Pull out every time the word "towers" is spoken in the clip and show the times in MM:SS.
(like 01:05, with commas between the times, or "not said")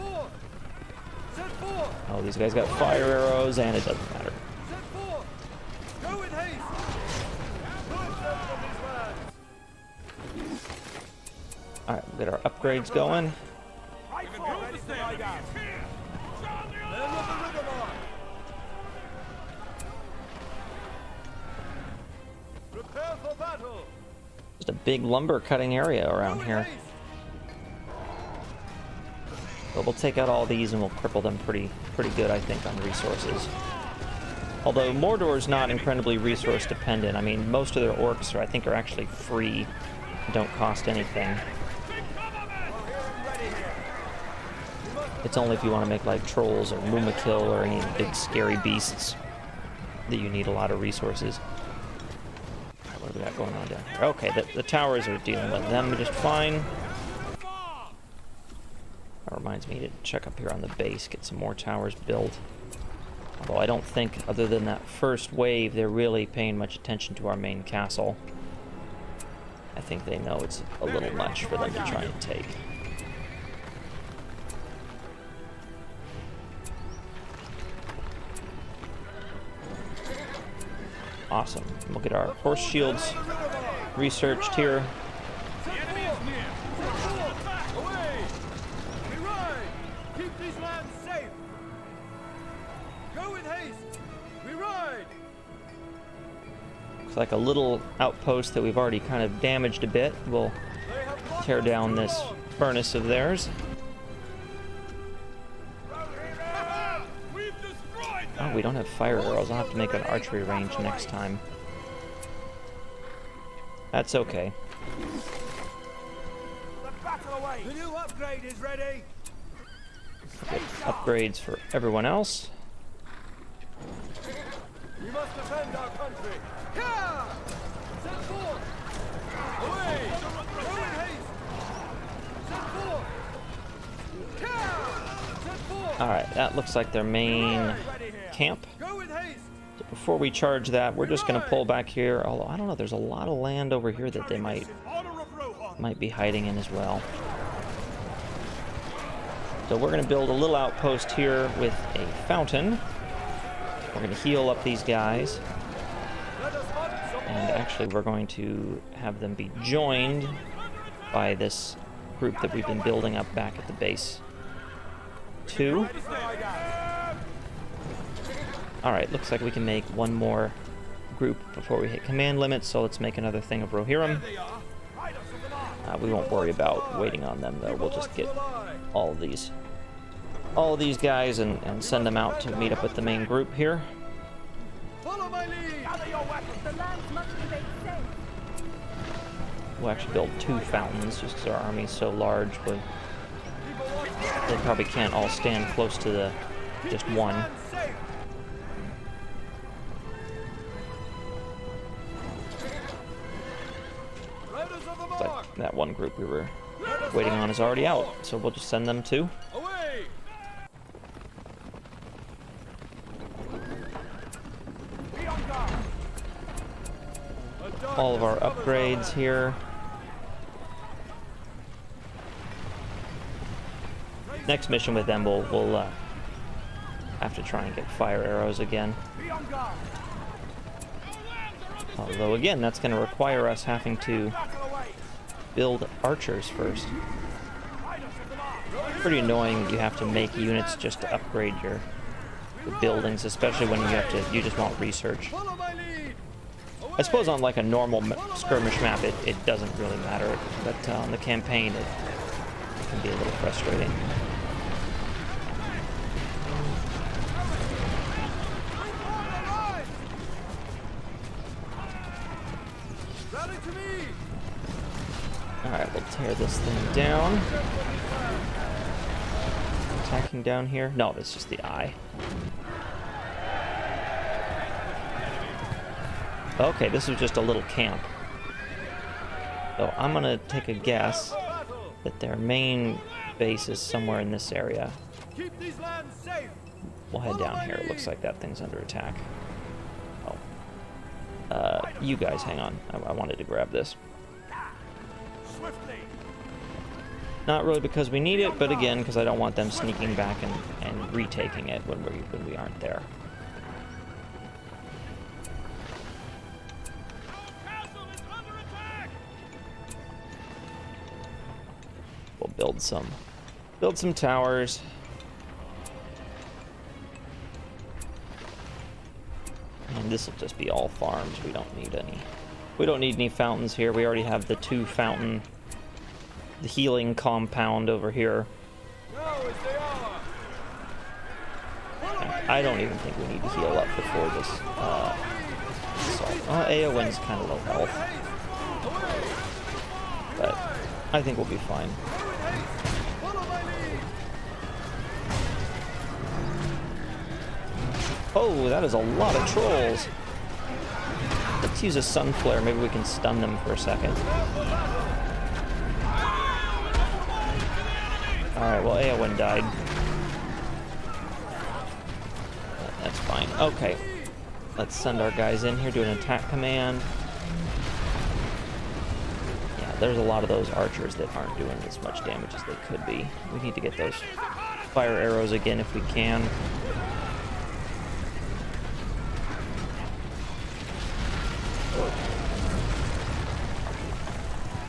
00:54, 01:01, 05:14.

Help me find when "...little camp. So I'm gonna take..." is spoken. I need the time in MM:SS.
04:37.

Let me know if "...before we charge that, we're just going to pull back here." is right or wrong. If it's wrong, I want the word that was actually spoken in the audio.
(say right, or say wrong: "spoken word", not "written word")
right.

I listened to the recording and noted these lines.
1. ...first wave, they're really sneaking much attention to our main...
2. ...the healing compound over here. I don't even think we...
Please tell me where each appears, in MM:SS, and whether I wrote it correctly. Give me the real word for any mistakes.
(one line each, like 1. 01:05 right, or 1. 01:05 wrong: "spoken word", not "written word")
1. 01:04 wrong: "paying", not "sneaking"
2. 05:26 right.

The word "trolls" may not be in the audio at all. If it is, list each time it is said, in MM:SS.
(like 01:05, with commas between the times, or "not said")
00:46, 05:49.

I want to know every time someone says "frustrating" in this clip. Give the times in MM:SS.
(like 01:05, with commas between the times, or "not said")
04:13.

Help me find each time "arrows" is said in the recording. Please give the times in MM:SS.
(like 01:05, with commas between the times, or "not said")
00:03, 01:49, 03:48, 06:15.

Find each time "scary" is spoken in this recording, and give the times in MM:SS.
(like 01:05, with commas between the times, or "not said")
00:48.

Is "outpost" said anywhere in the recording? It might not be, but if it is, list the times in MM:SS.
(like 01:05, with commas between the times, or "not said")
01:37, 02:30.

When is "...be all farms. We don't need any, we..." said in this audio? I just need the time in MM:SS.
05:20.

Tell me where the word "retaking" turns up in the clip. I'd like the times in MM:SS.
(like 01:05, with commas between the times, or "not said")
05:01.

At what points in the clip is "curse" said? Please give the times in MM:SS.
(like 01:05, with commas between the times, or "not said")
not said.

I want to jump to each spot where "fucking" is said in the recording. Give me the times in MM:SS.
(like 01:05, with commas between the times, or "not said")
not said.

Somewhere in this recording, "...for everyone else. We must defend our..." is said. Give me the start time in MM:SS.
02:01.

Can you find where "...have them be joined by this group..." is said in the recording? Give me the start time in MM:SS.
02:38.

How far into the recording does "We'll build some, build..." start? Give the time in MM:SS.
05:12.